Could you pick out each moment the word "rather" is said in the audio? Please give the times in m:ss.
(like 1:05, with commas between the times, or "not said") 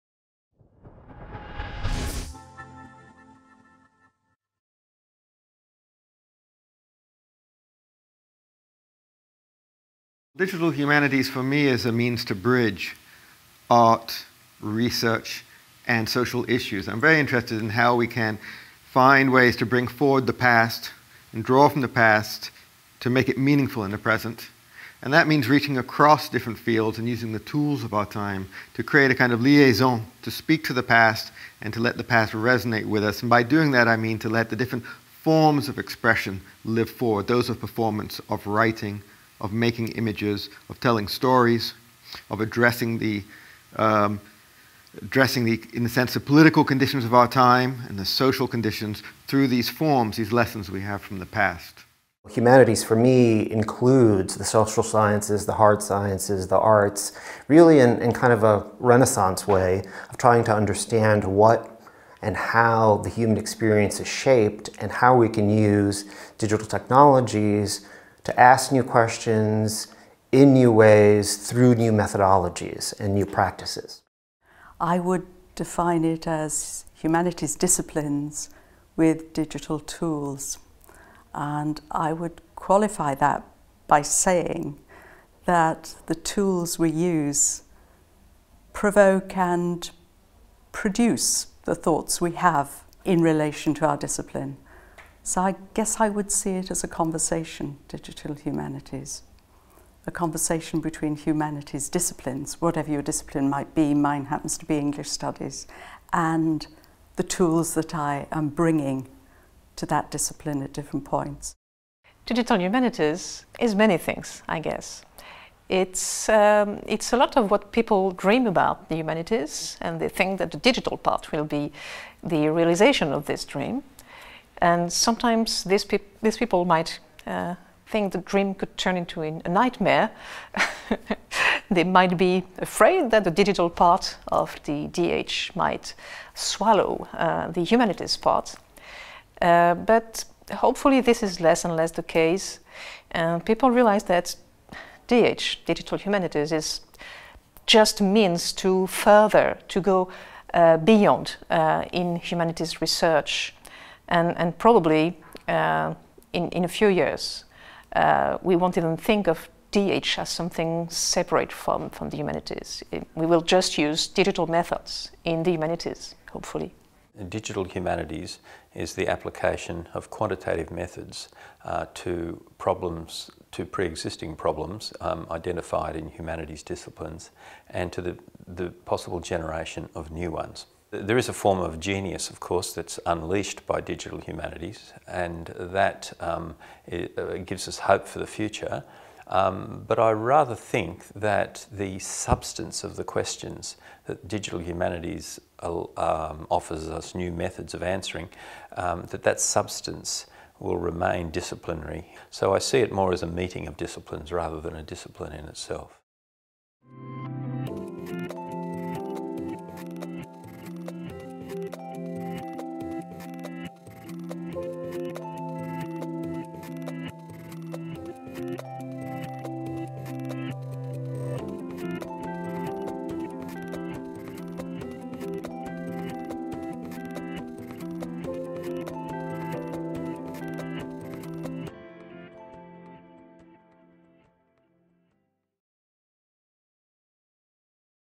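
3:10, 3:24.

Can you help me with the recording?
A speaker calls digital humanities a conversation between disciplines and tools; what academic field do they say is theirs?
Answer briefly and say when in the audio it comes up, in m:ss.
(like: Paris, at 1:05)
English studies, at 1:44.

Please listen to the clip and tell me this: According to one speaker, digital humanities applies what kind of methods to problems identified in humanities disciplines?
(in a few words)
quantitative methods.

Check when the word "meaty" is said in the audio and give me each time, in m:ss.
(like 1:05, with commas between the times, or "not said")
not said.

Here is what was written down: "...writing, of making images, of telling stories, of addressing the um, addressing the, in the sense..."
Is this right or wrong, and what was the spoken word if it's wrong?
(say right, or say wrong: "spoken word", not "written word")
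right.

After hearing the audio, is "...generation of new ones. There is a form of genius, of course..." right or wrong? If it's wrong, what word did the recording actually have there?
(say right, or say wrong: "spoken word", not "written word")
right.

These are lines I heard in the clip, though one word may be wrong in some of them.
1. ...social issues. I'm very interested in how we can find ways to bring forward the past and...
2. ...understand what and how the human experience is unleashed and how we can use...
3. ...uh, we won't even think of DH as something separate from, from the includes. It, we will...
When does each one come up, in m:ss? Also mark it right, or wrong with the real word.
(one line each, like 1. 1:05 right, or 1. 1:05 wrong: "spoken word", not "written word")
1. 0:16 right
2. 1:00 wrong: "shaped", not "unleashed"
3. 2:37 wrong: "humanities", not "includes".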